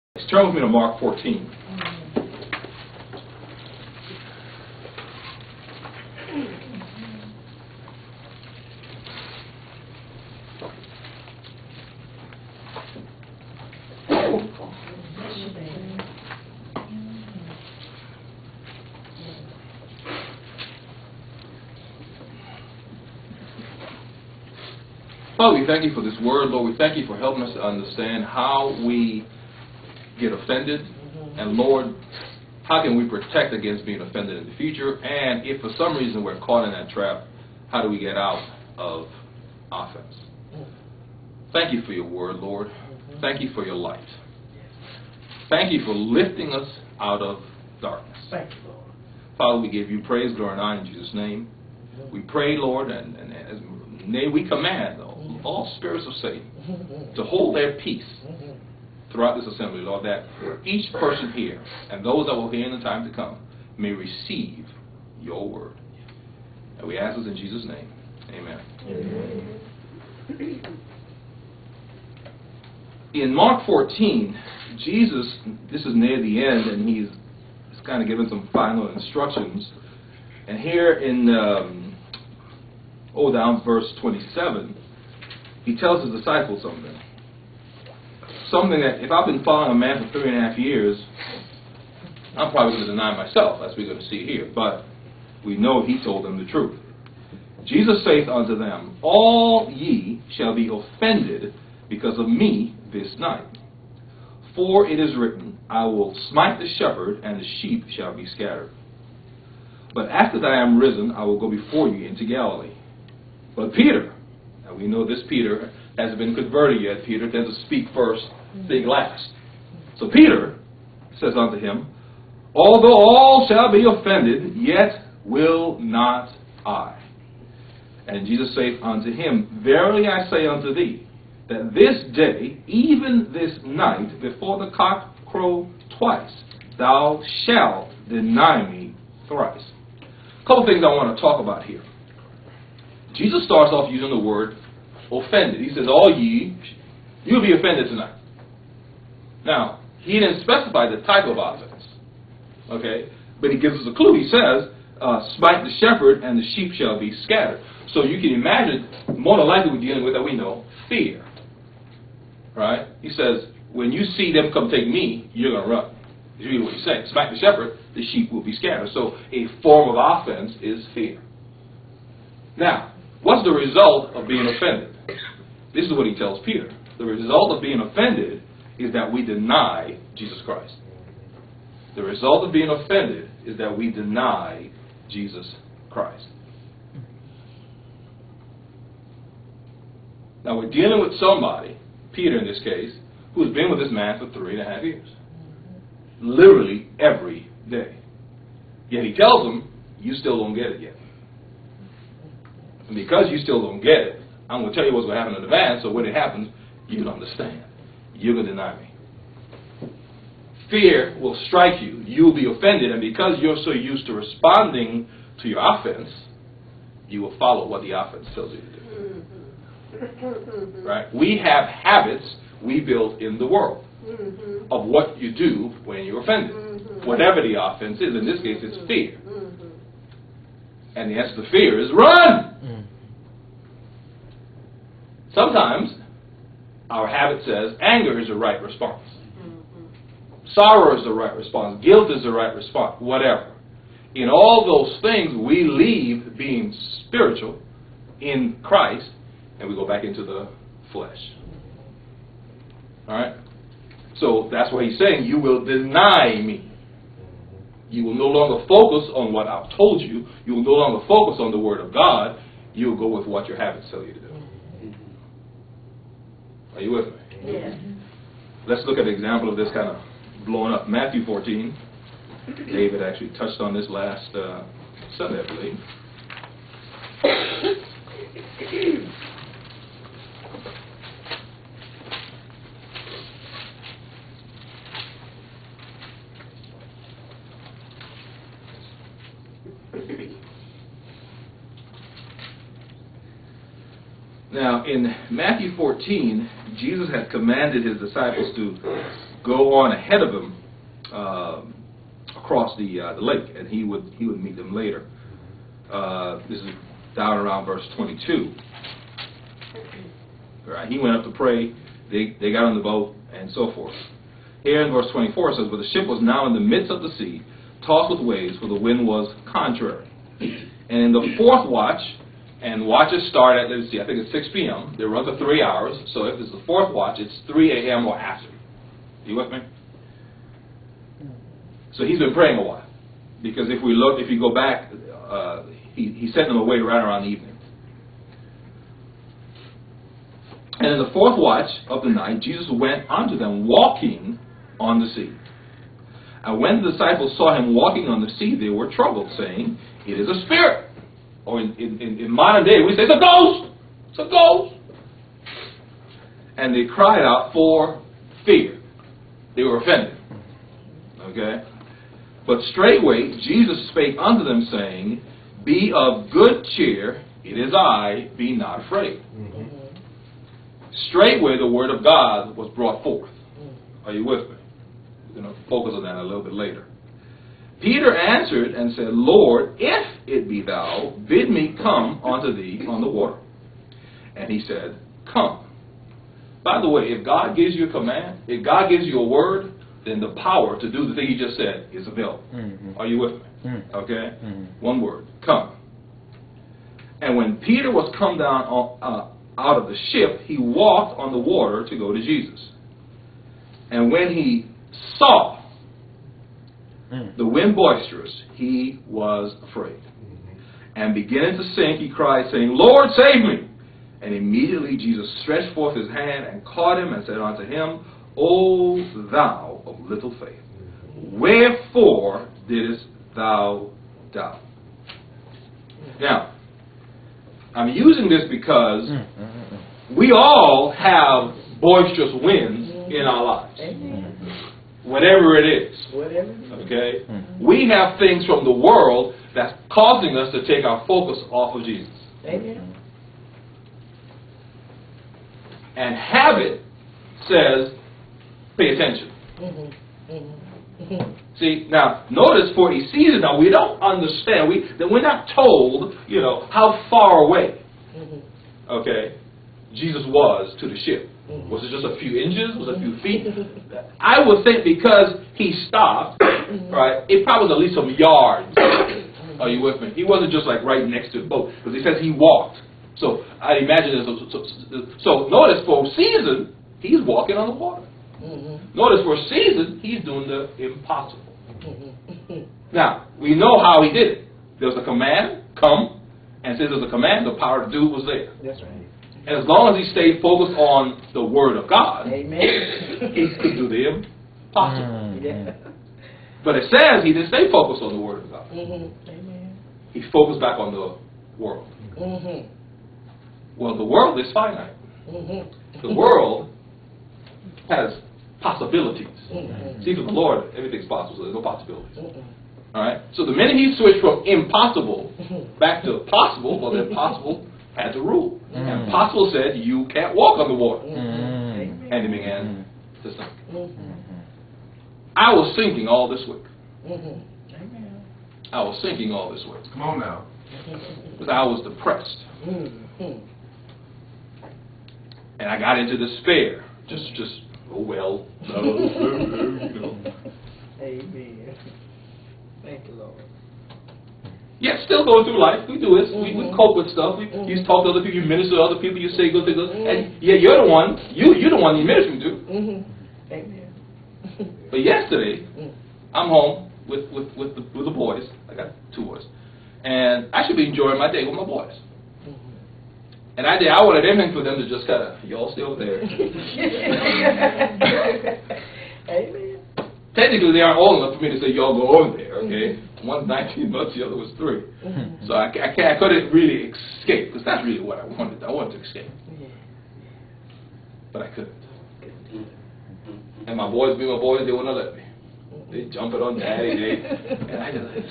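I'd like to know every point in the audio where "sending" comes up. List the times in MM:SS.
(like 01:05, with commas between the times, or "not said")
not said.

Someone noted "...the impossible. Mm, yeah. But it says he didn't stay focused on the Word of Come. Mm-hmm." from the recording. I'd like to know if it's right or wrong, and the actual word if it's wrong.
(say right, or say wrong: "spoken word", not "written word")
wrong: "God", not "Come".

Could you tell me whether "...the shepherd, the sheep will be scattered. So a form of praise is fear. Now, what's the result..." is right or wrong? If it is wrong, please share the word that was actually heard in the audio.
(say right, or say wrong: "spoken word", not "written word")
wrong: "offense", not "praise".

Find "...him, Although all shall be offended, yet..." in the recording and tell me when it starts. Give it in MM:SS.
02:01.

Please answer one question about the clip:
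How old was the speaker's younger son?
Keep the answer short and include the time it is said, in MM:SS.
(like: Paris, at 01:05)
19 months, at 09:33.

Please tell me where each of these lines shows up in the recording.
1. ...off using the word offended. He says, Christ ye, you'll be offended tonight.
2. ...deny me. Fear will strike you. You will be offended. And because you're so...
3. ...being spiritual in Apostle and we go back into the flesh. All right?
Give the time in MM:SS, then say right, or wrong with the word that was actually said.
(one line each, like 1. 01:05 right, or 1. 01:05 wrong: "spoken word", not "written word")
1. 02:23 wrong: "All", not "Christ"
2. 03:28 right
3. 04:06 wrong: "Christ", not "Apostle".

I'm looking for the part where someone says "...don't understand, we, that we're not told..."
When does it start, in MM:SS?
07:33.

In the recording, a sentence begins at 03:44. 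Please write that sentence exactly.
of what you do when you're offended, mm-hmm.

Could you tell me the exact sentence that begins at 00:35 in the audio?
And if for some reason we're caught in that trap, how do we get out of offense?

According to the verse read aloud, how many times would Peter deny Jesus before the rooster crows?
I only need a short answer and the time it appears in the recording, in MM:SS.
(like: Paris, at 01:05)
twice, at 02:15.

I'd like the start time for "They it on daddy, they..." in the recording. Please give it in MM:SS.
09:45.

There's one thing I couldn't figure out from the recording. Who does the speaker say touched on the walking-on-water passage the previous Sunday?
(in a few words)
David.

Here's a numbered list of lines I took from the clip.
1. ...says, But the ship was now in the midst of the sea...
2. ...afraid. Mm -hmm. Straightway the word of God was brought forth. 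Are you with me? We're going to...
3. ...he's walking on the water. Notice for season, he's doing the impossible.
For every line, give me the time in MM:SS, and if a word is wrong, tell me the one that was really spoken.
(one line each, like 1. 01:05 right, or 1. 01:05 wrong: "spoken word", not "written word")
1. 05:15 right
2. 06:08 right
3. 07:56 right.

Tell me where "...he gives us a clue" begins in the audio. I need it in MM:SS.
02:33.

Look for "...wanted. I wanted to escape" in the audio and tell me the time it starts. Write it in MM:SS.
09:38.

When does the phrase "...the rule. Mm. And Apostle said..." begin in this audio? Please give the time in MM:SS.
08:38.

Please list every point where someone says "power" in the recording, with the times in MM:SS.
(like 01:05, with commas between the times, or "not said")
06:30, 08:07.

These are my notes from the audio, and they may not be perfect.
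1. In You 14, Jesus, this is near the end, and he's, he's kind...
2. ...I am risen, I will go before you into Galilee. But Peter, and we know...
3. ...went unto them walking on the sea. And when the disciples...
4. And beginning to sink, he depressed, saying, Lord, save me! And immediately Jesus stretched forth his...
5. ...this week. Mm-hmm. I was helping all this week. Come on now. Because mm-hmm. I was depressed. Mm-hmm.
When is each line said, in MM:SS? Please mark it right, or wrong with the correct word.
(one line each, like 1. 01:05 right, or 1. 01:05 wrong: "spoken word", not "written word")
1. 01:13 wrong: "Mark", not "You"
2. 01:50 right
3. 05:42 right
4. 06:50 wrong: "cried", not "depressed"
5. 08:46 wrong: "sinking", not "helping".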